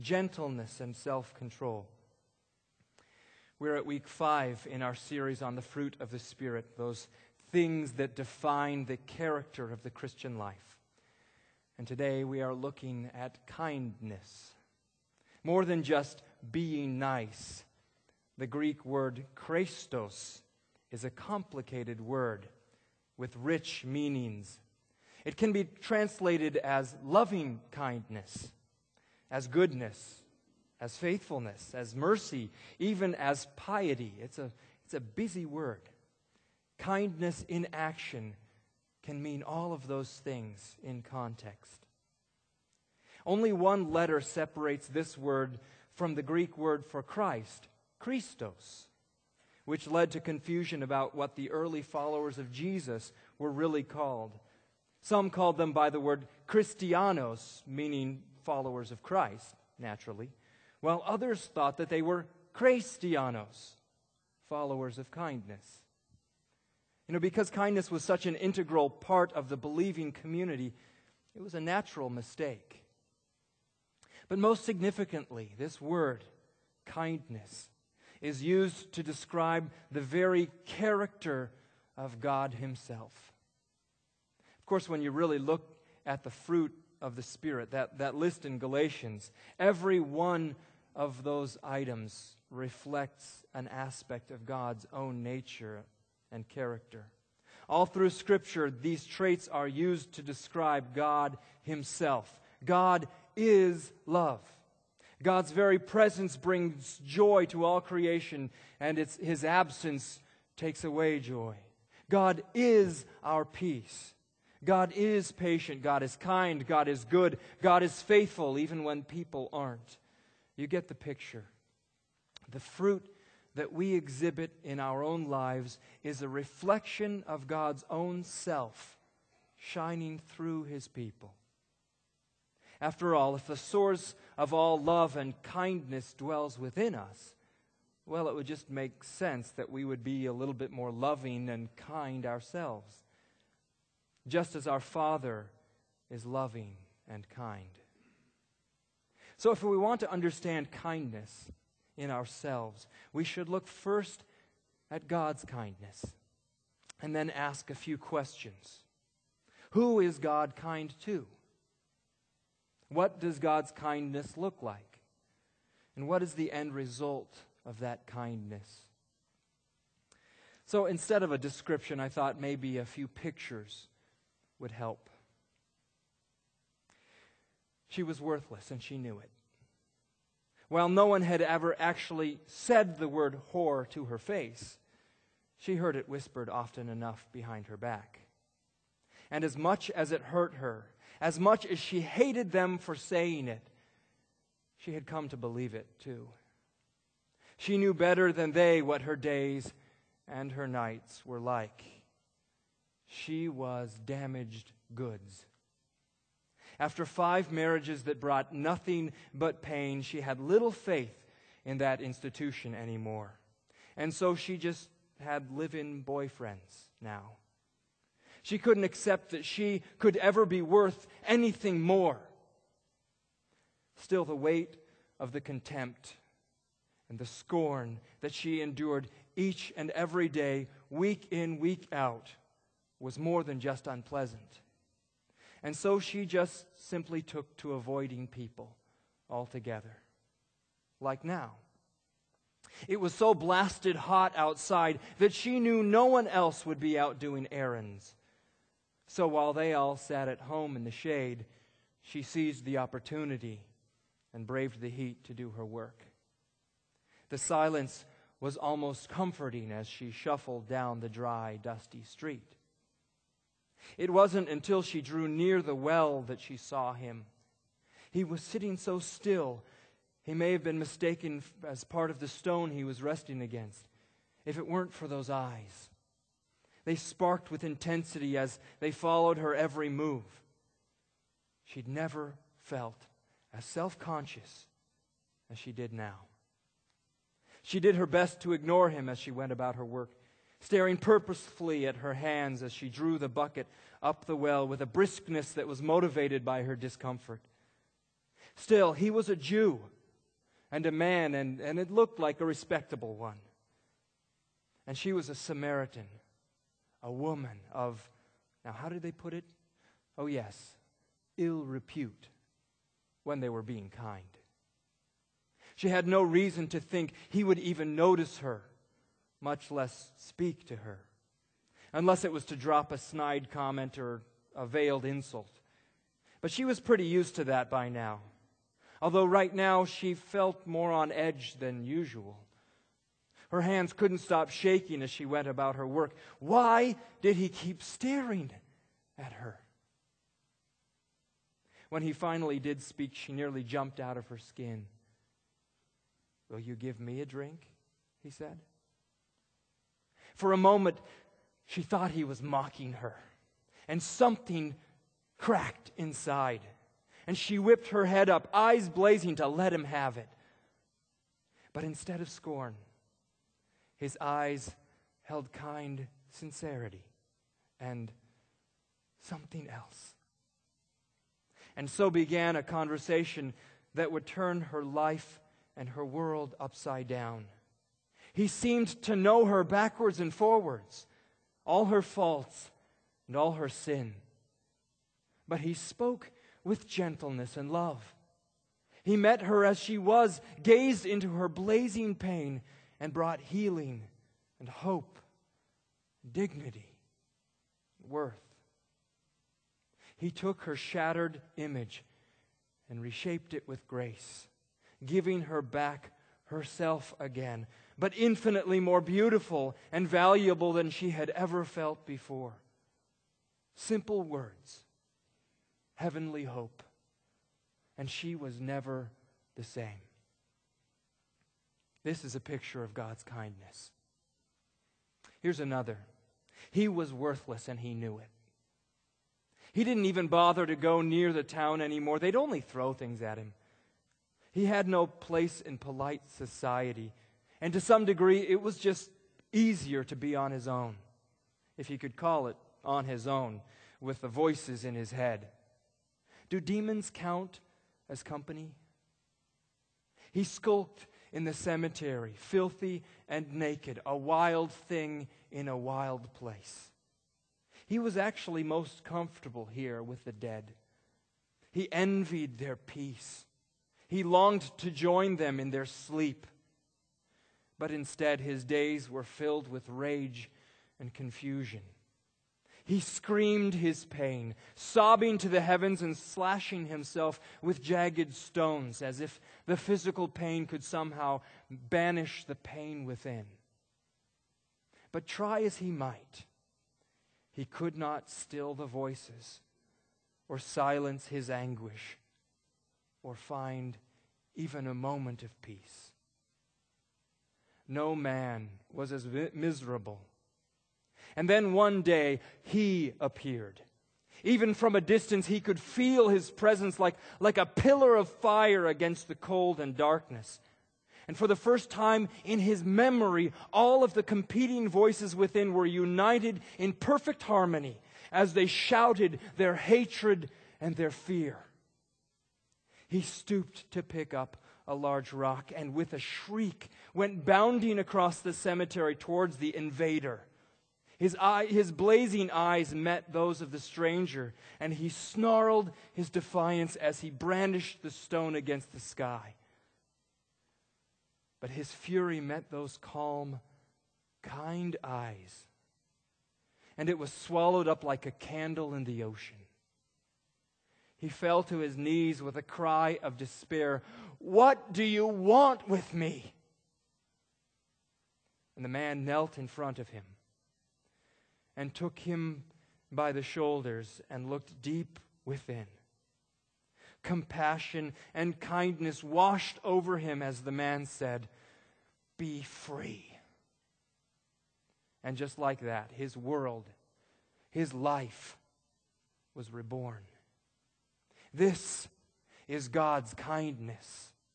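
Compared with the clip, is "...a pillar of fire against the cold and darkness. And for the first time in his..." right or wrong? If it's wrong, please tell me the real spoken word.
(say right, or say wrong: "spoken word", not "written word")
right.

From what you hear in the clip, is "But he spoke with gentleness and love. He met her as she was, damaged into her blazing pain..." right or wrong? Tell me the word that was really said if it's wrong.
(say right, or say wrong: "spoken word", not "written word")
wrong: "gazed", not "damaged".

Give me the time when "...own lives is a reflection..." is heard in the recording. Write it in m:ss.
2:05.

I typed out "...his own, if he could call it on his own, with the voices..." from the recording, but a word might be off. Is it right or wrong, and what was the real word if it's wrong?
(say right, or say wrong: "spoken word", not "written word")
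right.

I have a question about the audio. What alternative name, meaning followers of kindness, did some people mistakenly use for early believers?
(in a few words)
Chrestianos.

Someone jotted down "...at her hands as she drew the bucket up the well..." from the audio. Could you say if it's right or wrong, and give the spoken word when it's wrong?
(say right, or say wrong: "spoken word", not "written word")
right.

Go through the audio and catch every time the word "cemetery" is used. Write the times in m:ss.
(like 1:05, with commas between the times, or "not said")
7:31, 8:48.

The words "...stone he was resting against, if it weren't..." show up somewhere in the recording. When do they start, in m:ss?
4:32.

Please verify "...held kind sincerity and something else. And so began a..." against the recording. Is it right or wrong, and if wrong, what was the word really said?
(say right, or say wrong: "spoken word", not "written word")
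right.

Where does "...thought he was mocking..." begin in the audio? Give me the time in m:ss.
5:51.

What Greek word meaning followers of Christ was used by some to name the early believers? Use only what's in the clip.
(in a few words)
Christianos.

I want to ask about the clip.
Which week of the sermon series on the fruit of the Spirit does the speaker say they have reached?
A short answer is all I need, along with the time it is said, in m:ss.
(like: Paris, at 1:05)
Week 5, at 0:03.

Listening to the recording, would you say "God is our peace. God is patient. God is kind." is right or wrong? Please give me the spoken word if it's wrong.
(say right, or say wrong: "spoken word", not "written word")
right.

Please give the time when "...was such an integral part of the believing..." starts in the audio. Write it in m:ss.
1:07.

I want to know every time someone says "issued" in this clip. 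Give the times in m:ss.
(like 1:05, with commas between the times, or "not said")
not said.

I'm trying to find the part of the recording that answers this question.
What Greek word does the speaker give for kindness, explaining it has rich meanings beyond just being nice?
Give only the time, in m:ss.
0:19.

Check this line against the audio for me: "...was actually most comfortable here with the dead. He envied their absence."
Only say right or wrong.
wrong.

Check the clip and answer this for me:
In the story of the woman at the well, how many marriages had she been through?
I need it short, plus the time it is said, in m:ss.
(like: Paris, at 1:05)
5, at 3:27.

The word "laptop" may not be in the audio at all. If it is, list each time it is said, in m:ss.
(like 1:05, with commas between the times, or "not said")
not said.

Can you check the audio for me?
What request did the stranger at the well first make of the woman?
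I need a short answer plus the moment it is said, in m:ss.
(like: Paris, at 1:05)
Will you give me a drink?, at 5:46.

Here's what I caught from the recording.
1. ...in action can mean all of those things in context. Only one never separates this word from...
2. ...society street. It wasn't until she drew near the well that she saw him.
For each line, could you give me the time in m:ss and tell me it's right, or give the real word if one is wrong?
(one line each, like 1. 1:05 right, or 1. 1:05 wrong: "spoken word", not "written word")
1. 0:37 wrong: "letter", not "never"
2. 4:21 wrong: "dusty", not "society".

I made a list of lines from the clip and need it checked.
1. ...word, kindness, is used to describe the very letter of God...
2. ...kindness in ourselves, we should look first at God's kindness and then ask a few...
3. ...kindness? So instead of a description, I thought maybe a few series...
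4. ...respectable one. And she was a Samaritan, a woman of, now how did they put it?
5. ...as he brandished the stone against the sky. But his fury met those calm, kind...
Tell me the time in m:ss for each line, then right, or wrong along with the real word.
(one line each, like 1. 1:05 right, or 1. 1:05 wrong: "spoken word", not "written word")
1. 1:15 wrong: "character", not "letter"
2. 2:30 right
3. 2:48 wrong: "pictures", not "series"
4. 5:02 right
5. 8:56 right.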